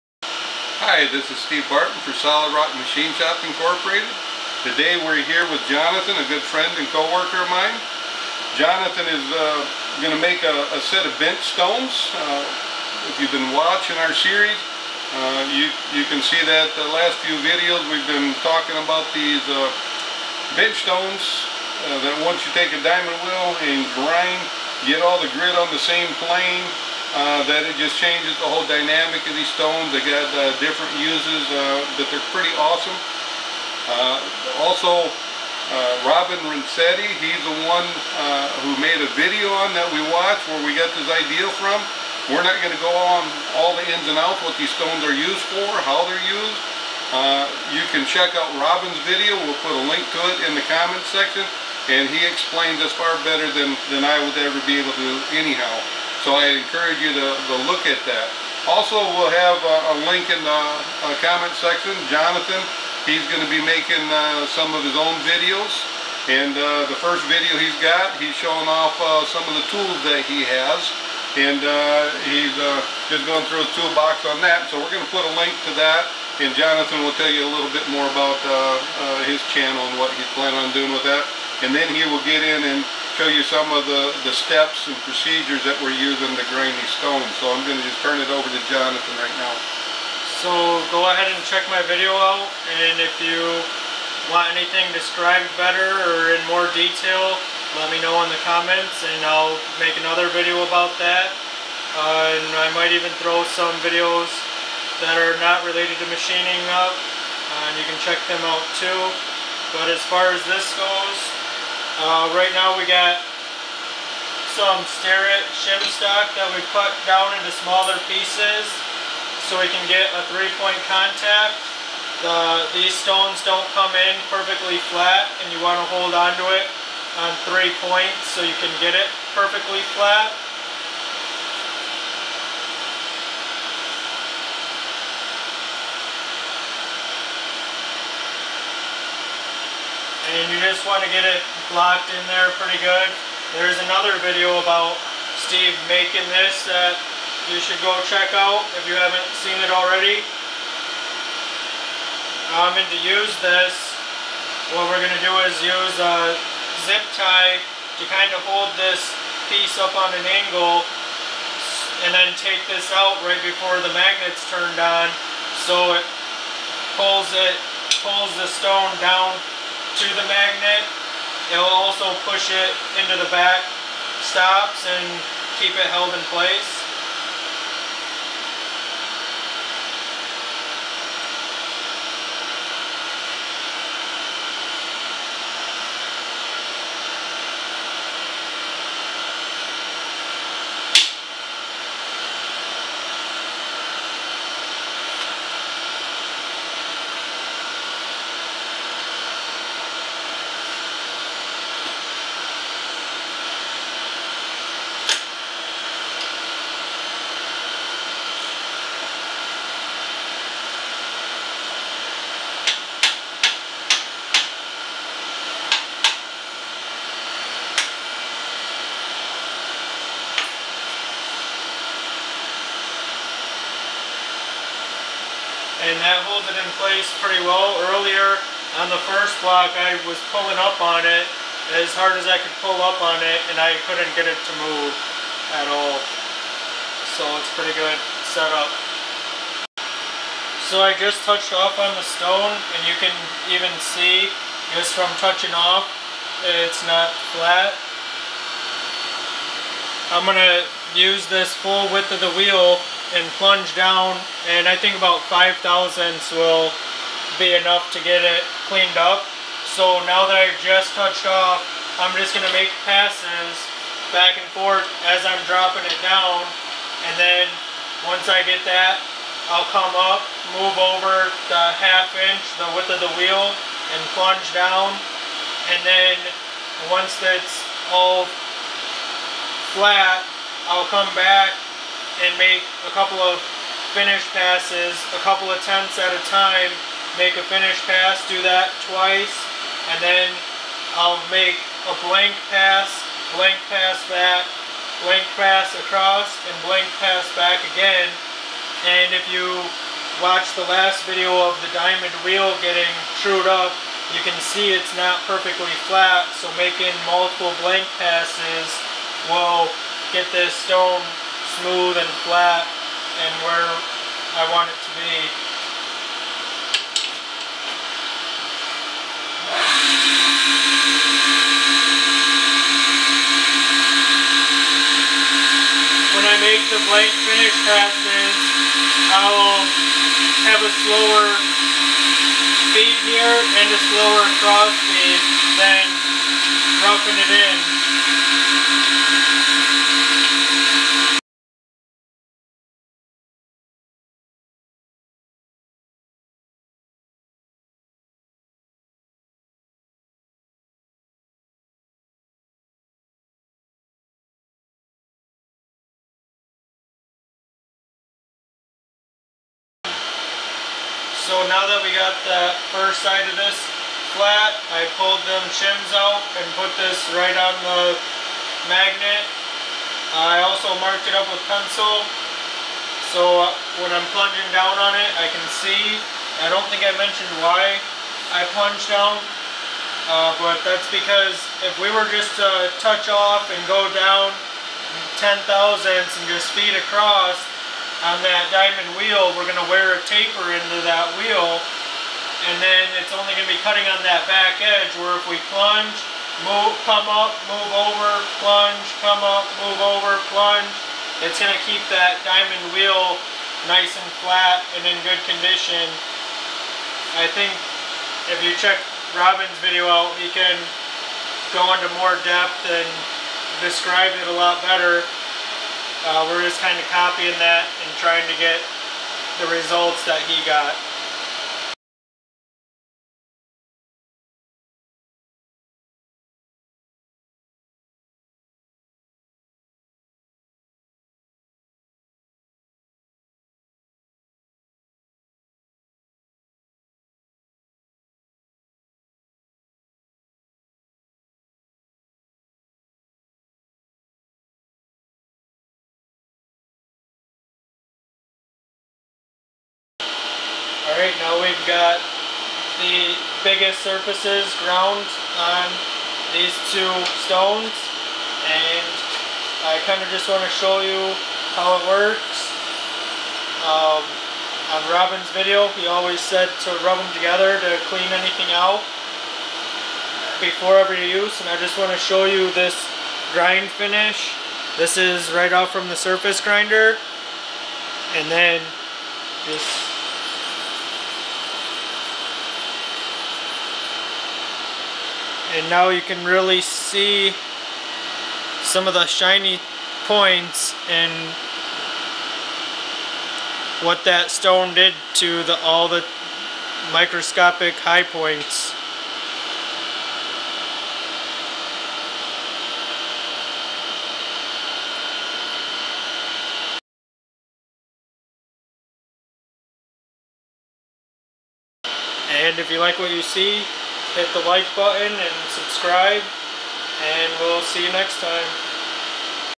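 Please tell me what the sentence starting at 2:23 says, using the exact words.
There's another video about Steve making this that you should go check out if you haven't seen it already.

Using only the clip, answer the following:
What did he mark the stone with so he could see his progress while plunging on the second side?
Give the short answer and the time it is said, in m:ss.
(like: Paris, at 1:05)
pencil, at 6:11.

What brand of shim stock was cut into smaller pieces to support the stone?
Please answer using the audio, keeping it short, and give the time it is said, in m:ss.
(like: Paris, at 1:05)
Starrett, at 1:54.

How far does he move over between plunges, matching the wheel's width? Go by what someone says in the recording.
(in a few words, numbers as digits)
half inch.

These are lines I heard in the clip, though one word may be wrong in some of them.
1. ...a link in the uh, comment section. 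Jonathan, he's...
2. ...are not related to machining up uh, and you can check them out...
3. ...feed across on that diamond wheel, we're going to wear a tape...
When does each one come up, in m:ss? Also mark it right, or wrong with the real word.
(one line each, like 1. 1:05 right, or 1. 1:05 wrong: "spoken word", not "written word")
1. 0:59 right
2. 1:45 right
3. 6:26 right.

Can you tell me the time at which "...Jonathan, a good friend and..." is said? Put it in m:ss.
0:05.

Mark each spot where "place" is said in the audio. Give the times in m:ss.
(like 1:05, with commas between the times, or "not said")
2:56, 3:46.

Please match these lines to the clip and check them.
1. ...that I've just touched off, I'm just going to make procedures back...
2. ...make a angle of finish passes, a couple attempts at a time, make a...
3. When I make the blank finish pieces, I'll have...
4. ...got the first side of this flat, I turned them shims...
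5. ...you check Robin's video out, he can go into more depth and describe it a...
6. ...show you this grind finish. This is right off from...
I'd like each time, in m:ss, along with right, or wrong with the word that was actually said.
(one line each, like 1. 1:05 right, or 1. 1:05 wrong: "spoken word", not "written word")
1. 4:20 wrong: "passes", not "procedures"
2. 4:42 wrong: "couple", not "angle"
3. 5:26 wrong: "passes", not "pieces"
4. 6:01 wrong: "pulled", not "turned"
5. 6:48 right
6. 7:51 right.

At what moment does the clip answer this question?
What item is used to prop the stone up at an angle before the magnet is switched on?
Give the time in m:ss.
2:36.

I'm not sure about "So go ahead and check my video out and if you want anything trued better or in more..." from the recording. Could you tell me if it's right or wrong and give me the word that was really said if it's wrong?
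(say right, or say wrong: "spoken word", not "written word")
wrong: "described", not "trued".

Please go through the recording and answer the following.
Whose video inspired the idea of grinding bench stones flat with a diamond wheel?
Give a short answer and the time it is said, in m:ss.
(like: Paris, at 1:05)
Robin Renzetti, at 0:36.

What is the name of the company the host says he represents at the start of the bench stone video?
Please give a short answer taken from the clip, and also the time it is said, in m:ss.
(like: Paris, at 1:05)
Solid Rock Machine Shop Incorporated, at 0:02.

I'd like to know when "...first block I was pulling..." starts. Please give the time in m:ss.
3:49.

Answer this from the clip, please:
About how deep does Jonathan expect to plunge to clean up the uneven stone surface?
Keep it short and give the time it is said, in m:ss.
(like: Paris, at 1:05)
5 thousandths, at 4:15.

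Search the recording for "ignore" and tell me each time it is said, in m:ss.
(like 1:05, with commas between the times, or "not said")
not said.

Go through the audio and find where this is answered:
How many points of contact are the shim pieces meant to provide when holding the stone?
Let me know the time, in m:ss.
2:00.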